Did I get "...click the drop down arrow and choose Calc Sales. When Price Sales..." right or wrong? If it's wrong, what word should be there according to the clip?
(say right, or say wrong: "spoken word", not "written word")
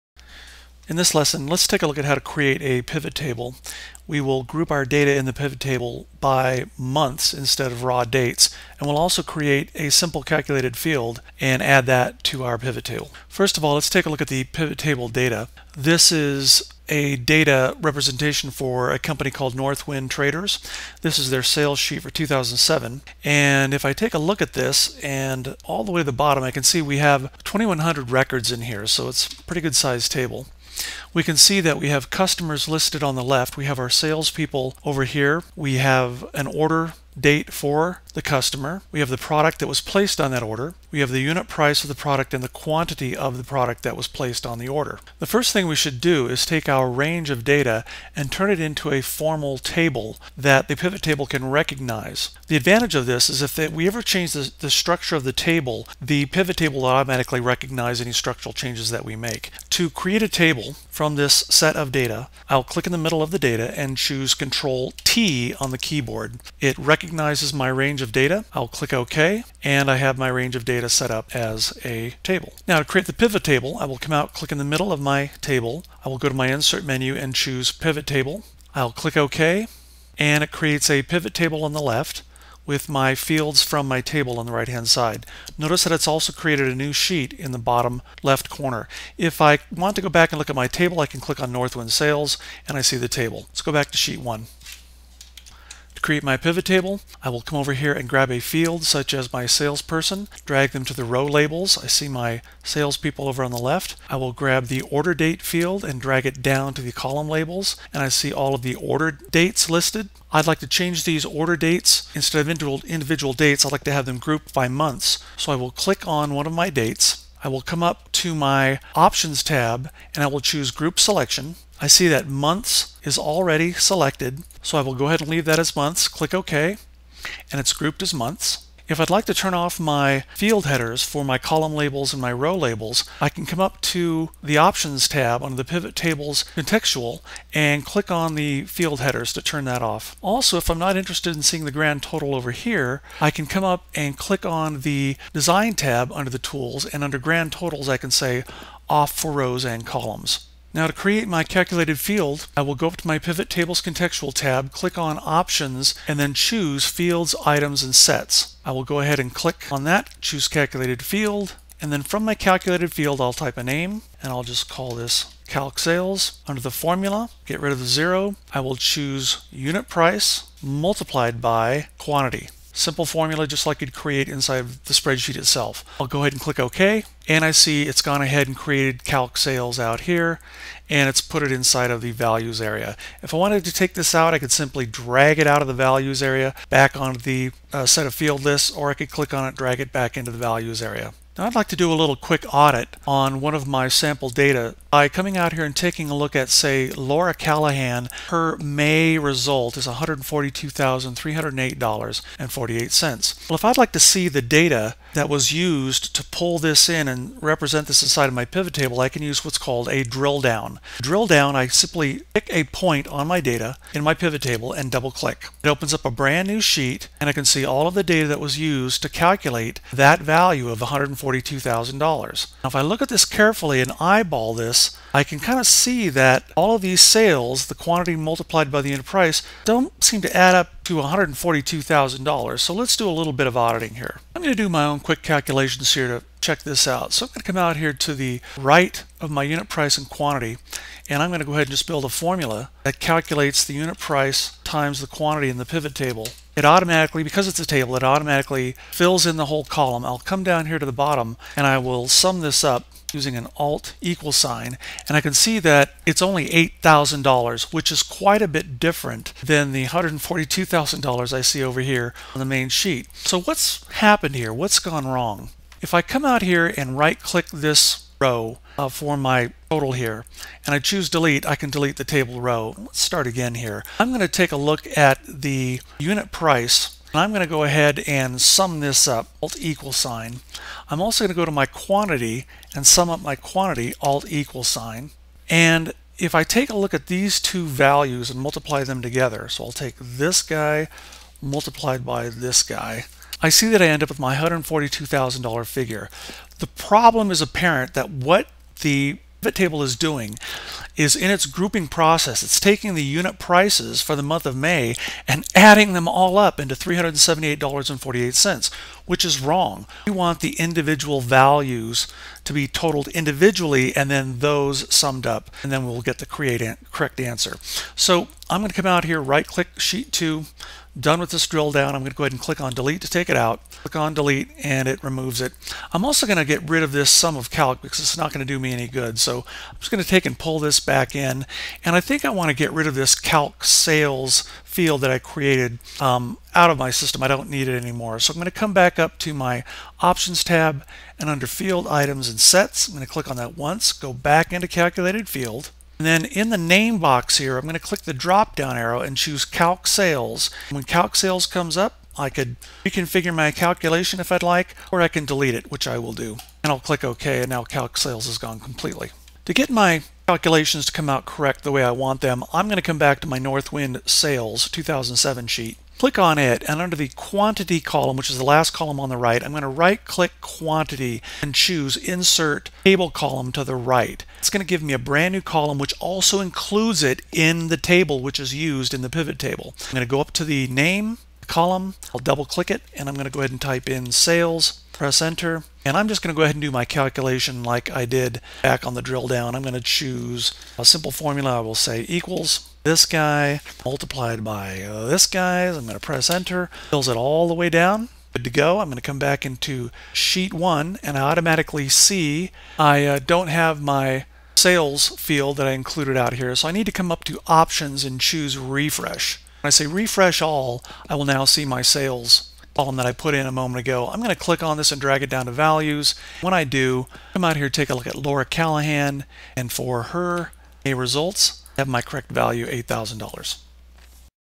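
wrong: "Calc", not "Price".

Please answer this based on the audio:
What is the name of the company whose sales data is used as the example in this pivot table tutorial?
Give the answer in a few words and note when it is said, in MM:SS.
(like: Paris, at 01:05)
Northwind Traders, at 00:19.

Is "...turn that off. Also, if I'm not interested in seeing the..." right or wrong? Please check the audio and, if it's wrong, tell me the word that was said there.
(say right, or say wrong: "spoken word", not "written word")
right.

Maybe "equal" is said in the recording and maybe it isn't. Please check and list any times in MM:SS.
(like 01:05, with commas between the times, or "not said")
04:14, 04:39, 04:44, 06:32.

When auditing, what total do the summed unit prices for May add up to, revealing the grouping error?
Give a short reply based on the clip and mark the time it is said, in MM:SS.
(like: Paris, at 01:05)
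$378.48, at 05:06.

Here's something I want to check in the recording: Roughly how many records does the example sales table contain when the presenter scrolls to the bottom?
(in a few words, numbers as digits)
2,100.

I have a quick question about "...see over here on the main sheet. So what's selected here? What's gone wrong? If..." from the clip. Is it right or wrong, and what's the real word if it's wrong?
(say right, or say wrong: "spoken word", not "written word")
wrong: "happened", not "selected".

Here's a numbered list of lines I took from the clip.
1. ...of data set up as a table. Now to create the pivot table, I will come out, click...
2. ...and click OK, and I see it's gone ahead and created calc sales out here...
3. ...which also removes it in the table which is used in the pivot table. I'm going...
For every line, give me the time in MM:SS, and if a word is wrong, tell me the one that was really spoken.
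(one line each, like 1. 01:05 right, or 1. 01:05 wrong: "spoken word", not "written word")
1. 01:10 right
2. 02:56 right
3. 06:15 wrong: "includes", not "removes".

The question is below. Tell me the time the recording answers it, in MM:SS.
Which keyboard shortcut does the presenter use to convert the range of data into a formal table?
01:04.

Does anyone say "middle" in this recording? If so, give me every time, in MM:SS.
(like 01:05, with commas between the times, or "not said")
01:02, 01:14.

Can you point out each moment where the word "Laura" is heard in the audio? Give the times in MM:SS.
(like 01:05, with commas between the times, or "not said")
03:16, 06:58.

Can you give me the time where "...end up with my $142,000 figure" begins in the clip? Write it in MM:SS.
04:53.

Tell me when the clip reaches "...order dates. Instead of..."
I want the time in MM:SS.
01:51.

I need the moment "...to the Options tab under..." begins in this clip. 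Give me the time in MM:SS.
02:13.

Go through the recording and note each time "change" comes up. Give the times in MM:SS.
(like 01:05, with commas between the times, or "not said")
00:54, 00:58, 01:50.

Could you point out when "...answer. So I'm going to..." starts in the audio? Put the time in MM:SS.
05:17.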